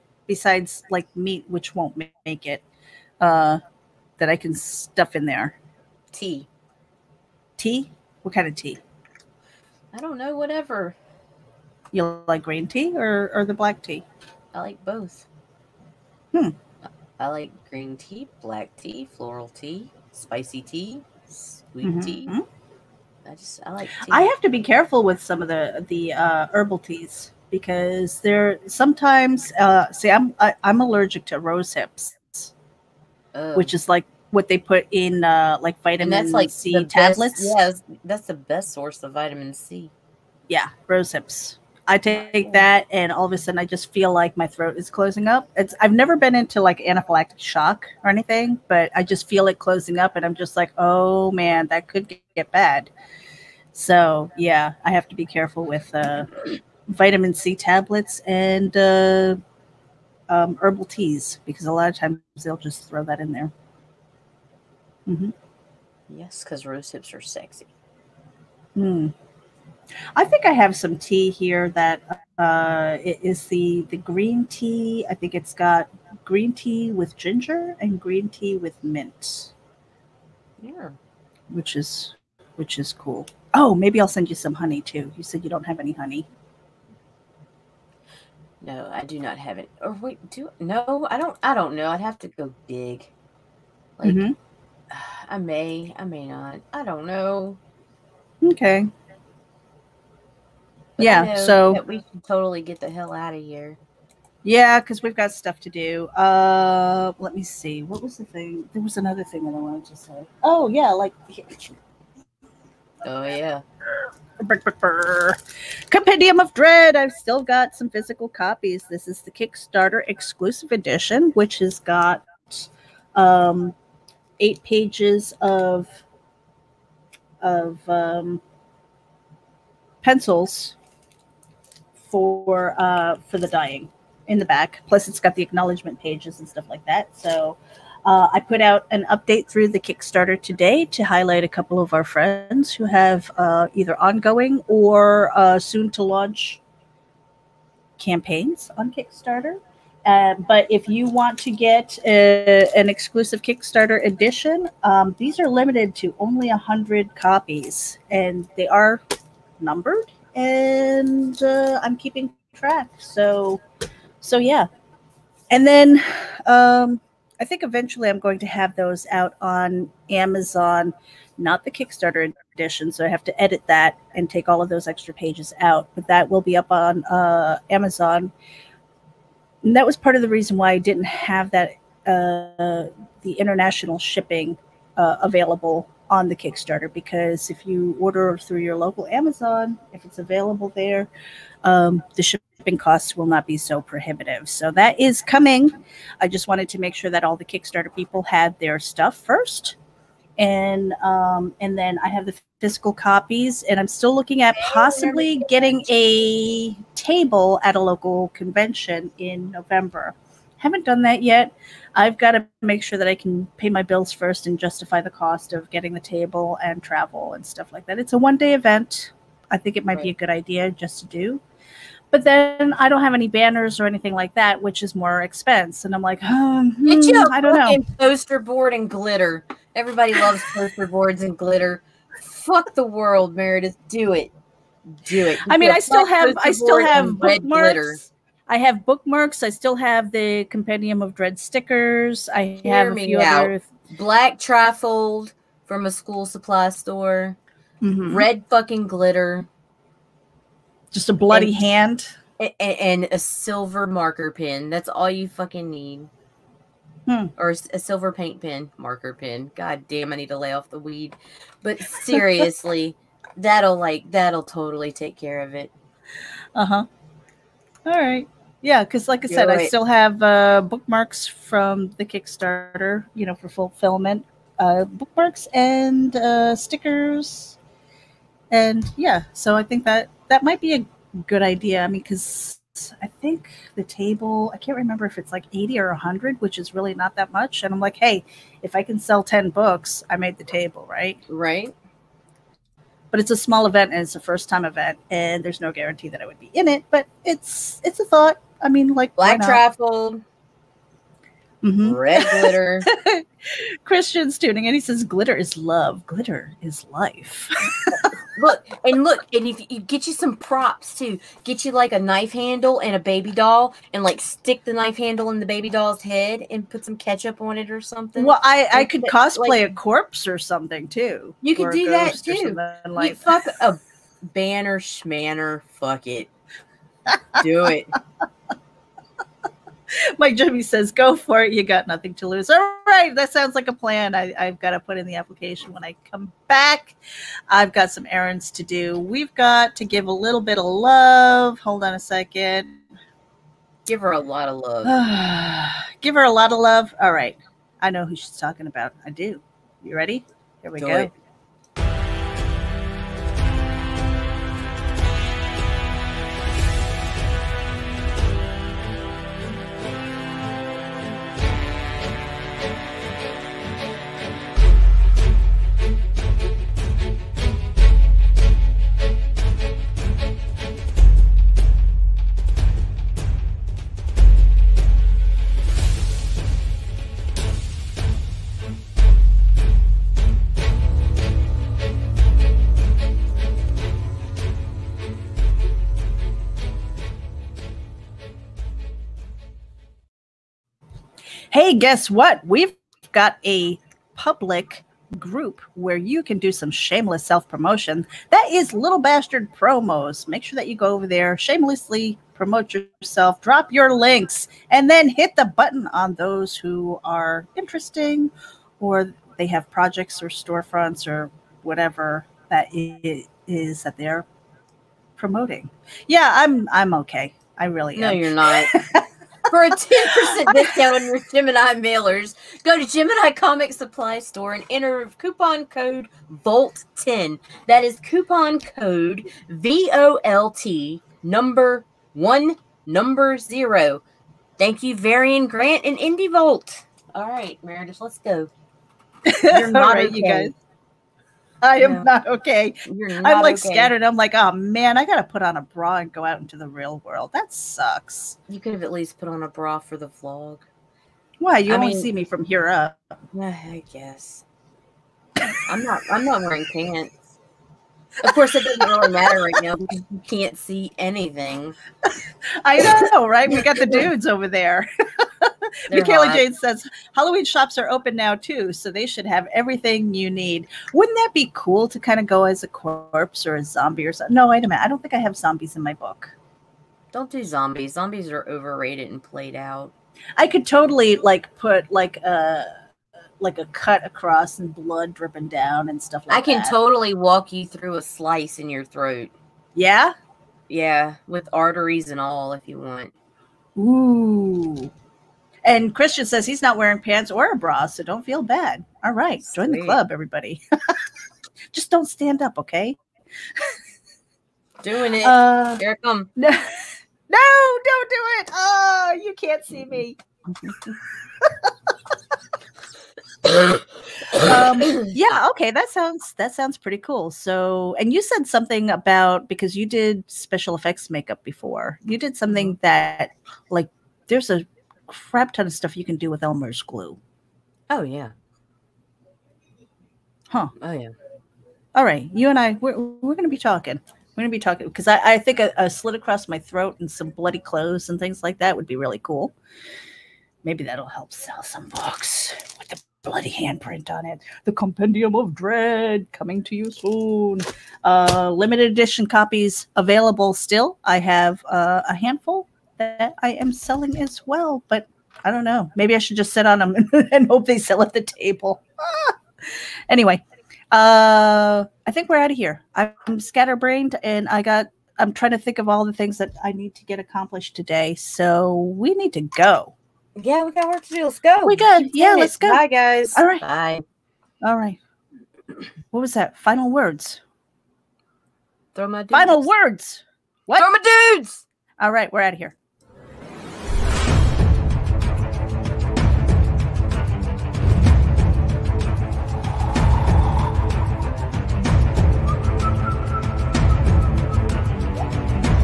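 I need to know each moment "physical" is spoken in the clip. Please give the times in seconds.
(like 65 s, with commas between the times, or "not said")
117 s, 202 s.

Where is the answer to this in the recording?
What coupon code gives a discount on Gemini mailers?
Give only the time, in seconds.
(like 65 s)
426 s.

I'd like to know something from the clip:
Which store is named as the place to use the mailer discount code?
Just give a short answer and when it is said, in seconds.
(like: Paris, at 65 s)
Gemini Comic Supply Store, at 422 s.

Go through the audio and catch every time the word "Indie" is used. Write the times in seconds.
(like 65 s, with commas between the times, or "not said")
435 s.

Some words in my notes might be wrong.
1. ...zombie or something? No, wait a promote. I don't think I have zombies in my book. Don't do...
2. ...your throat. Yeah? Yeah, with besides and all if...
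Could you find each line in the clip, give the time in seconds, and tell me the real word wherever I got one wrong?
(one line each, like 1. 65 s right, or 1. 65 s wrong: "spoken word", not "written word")
1. 473 s wrong: "minute", not "promote"
2. 488 s wrong: "arteries", not "besides".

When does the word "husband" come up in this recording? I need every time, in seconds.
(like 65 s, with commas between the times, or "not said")
not said.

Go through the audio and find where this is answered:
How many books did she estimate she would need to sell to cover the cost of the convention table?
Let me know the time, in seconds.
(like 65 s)
289 s.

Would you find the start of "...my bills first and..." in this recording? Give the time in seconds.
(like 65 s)
213 s.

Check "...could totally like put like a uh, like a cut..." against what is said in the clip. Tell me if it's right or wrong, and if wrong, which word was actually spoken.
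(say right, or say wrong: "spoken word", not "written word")
right.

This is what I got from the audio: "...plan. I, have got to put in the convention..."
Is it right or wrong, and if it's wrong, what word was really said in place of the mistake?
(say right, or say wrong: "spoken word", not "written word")
wrong: "application", not "convention".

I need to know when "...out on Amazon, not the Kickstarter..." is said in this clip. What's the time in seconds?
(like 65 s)
169 s.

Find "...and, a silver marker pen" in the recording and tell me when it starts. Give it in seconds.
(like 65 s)
252 s.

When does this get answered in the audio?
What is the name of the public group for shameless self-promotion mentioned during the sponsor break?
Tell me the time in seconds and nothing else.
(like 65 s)
398 s.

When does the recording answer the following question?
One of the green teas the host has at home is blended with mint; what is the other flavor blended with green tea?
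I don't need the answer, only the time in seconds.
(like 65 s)
77 s.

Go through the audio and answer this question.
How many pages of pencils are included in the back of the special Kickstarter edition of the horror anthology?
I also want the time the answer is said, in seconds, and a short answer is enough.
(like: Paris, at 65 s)
8, at 124 s.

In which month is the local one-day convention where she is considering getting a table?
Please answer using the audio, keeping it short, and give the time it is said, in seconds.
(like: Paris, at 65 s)
November, at 209 s.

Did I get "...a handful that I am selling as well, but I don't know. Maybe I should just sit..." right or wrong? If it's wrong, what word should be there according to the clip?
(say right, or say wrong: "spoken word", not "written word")
right.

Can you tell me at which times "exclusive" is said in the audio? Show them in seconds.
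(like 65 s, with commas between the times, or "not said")
120 s, 152 s.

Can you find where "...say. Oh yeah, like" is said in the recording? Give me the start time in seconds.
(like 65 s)
109 s.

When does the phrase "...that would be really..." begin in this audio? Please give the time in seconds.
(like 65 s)
538 s.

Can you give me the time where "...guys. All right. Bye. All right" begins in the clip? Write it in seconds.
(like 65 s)
572 s.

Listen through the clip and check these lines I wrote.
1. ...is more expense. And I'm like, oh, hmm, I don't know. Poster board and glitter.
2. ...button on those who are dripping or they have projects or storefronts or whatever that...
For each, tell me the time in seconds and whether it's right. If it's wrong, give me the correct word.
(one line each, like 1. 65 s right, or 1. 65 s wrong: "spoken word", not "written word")
1. 224 s right
2. 405 s wrong: "interesting", not "dripping".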